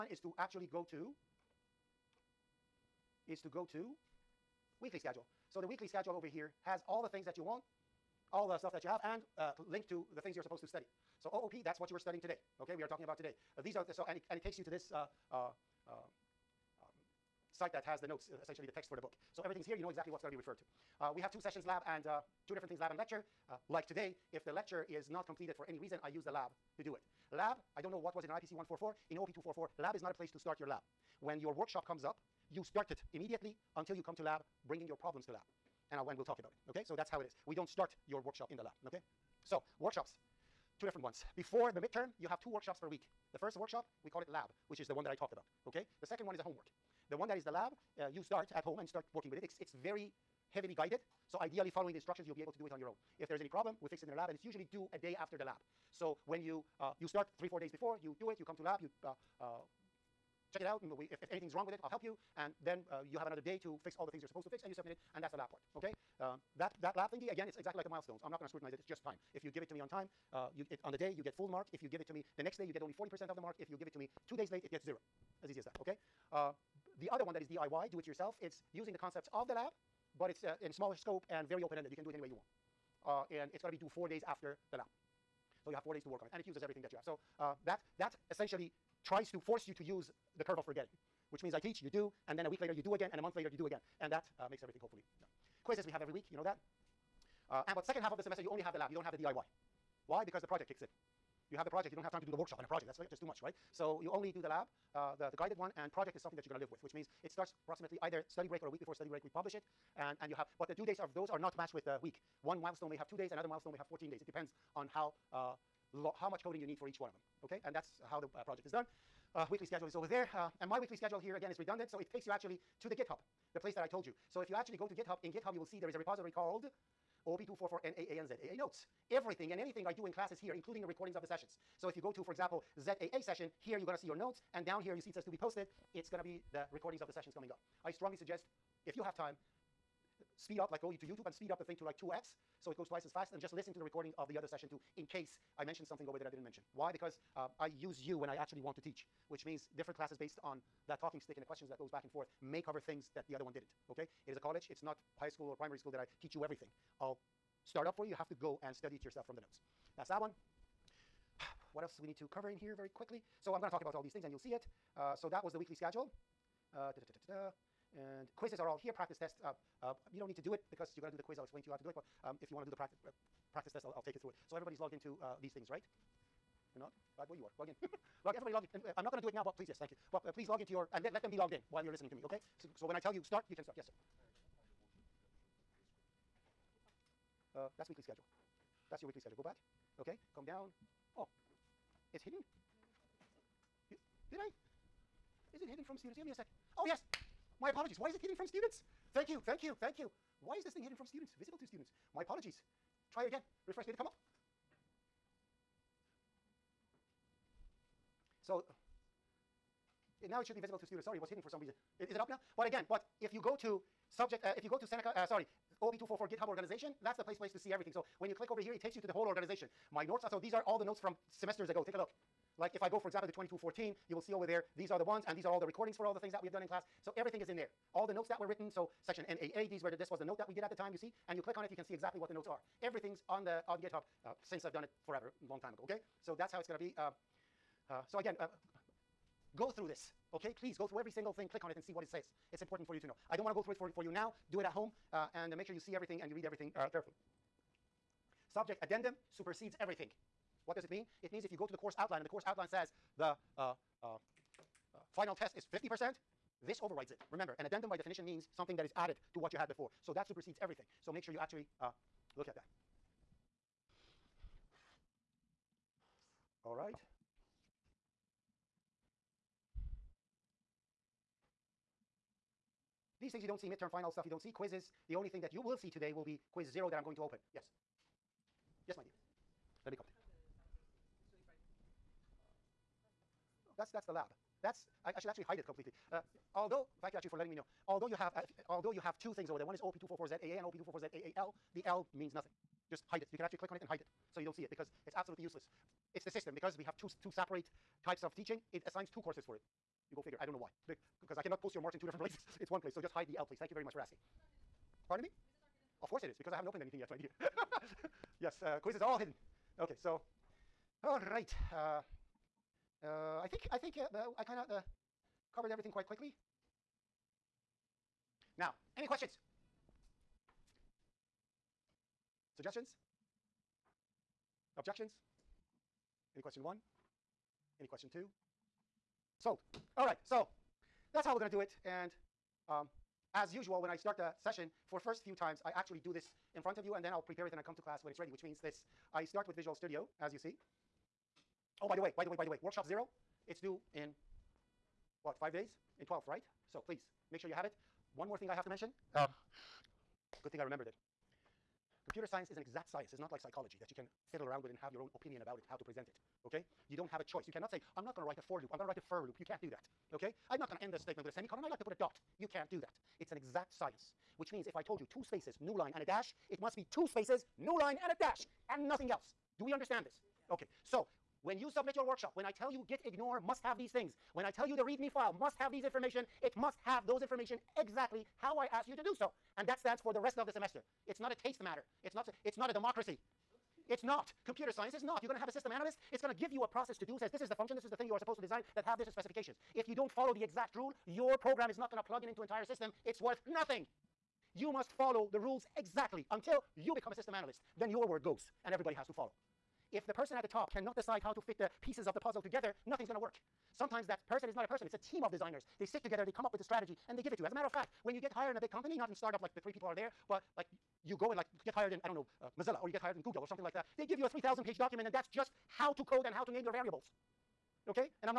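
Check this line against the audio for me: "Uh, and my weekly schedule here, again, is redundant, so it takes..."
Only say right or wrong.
right.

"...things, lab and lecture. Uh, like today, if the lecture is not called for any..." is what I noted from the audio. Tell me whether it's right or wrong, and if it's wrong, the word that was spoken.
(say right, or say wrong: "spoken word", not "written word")
wrong: "completed", not "called".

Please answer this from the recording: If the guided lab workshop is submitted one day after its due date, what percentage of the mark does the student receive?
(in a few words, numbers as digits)
40%.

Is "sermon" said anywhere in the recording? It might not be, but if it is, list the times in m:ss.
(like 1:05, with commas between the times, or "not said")
not said.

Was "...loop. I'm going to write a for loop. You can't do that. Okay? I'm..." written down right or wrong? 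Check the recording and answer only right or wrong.
right.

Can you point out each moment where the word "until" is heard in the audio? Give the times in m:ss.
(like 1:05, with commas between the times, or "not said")
0:33, 6:36.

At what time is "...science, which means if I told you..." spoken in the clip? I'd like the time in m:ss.
6:03.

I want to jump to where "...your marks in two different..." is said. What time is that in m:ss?
5:01.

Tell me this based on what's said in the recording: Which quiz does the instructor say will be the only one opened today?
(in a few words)
quiz 0.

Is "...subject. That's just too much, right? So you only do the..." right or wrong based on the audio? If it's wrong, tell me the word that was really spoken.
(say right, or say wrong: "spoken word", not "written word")
wrong: "project", not "subject".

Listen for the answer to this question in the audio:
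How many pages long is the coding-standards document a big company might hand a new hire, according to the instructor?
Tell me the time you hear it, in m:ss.
6:54.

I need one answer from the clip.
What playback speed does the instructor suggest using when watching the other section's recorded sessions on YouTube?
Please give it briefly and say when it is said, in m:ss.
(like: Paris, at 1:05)
2x, at 2:21.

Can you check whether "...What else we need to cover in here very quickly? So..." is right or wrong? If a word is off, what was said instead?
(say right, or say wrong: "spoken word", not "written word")
right.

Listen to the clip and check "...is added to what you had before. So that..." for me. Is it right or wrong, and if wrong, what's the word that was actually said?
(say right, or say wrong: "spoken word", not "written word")
right.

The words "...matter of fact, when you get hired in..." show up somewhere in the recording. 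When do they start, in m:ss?
6:47.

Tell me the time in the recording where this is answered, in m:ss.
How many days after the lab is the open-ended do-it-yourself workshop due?
1:23.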